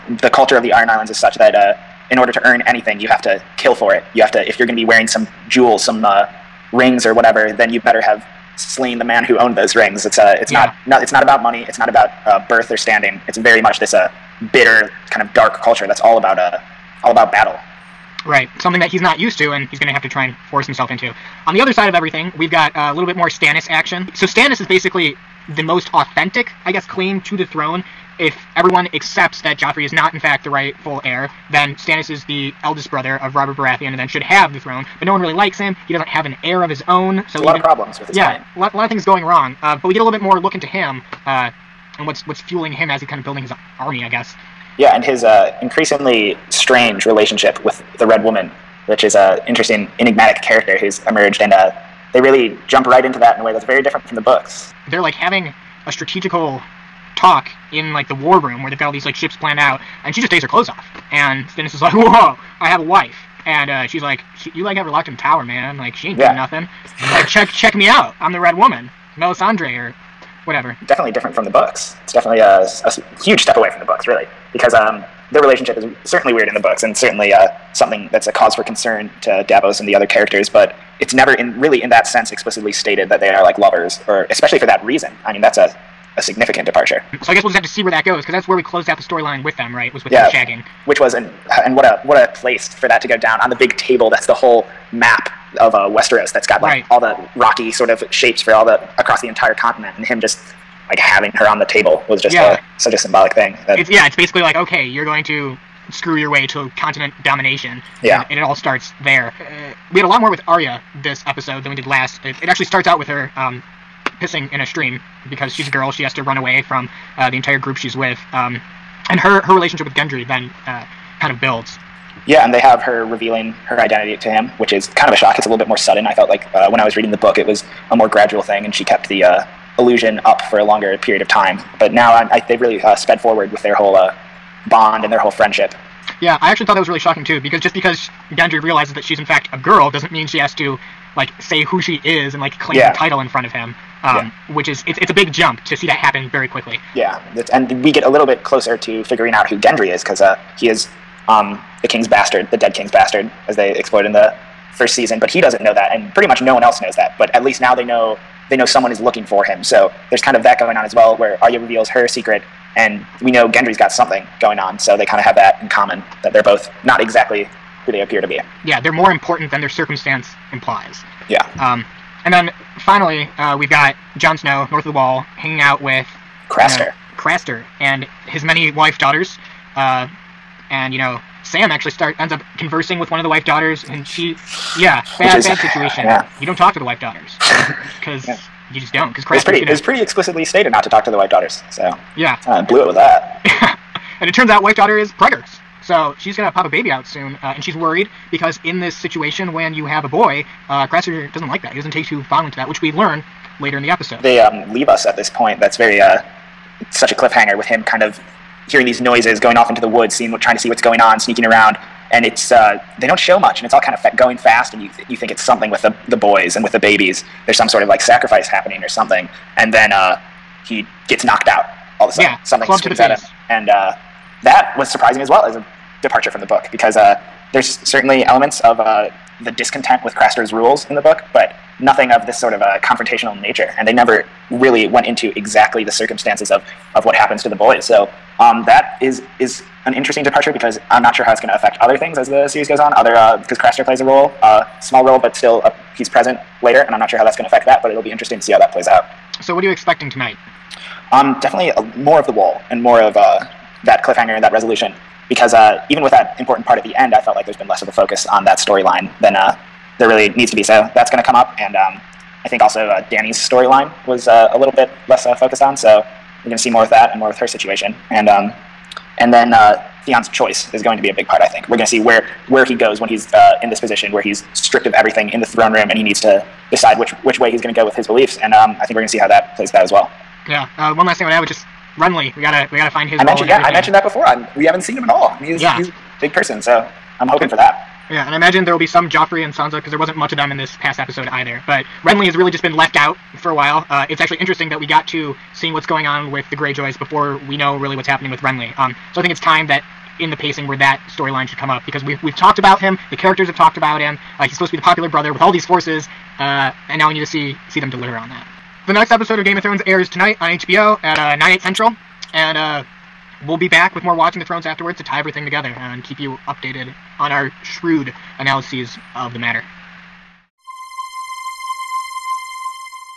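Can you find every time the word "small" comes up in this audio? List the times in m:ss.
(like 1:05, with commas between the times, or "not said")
4:04.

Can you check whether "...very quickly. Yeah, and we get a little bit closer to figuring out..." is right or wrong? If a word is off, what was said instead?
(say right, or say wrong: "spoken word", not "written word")
right.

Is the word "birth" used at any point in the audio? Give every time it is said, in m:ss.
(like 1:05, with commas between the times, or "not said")
0:12.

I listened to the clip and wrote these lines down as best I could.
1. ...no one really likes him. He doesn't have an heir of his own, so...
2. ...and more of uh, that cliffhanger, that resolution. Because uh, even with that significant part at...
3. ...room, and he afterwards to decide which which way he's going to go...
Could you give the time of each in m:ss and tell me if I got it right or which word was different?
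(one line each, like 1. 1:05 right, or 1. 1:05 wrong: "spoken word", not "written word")
1. 0:35 right
2. 4:12 wrong: "important", not "significant"
3. 4:35 wrong: "needs", not "afterwards".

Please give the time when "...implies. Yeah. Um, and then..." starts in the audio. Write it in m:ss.
2:50.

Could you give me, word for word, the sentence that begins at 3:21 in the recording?
He doesn't take too fondly to that, which we learn later in the episode.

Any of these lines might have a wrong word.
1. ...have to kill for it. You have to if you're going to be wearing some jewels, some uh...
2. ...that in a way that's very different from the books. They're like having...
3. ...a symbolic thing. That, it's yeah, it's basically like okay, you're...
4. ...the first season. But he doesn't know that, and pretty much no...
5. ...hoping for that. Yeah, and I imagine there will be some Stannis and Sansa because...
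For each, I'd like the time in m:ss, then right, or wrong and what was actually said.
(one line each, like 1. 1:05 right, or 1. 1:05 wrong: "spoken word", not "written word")
1. 0:03 right
2. 0:53 right
3. 1:42 right
4. 2:34 right
5. 4:47 wrong: "Joffrey", not "Stannis".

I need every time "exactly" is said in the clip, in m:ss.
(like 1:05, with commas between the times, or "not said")
2:46, 3:55.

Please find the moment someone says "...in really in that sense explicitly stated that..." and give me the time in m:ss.
1:21.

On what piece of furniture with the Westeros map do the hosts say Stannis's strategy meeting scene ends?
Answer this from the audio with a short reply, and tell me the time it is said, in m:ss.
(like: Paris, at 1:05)
The table, at 1:33.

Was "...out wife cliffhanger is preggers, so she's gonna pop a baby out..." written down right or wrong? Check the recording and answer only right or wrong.
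wrong.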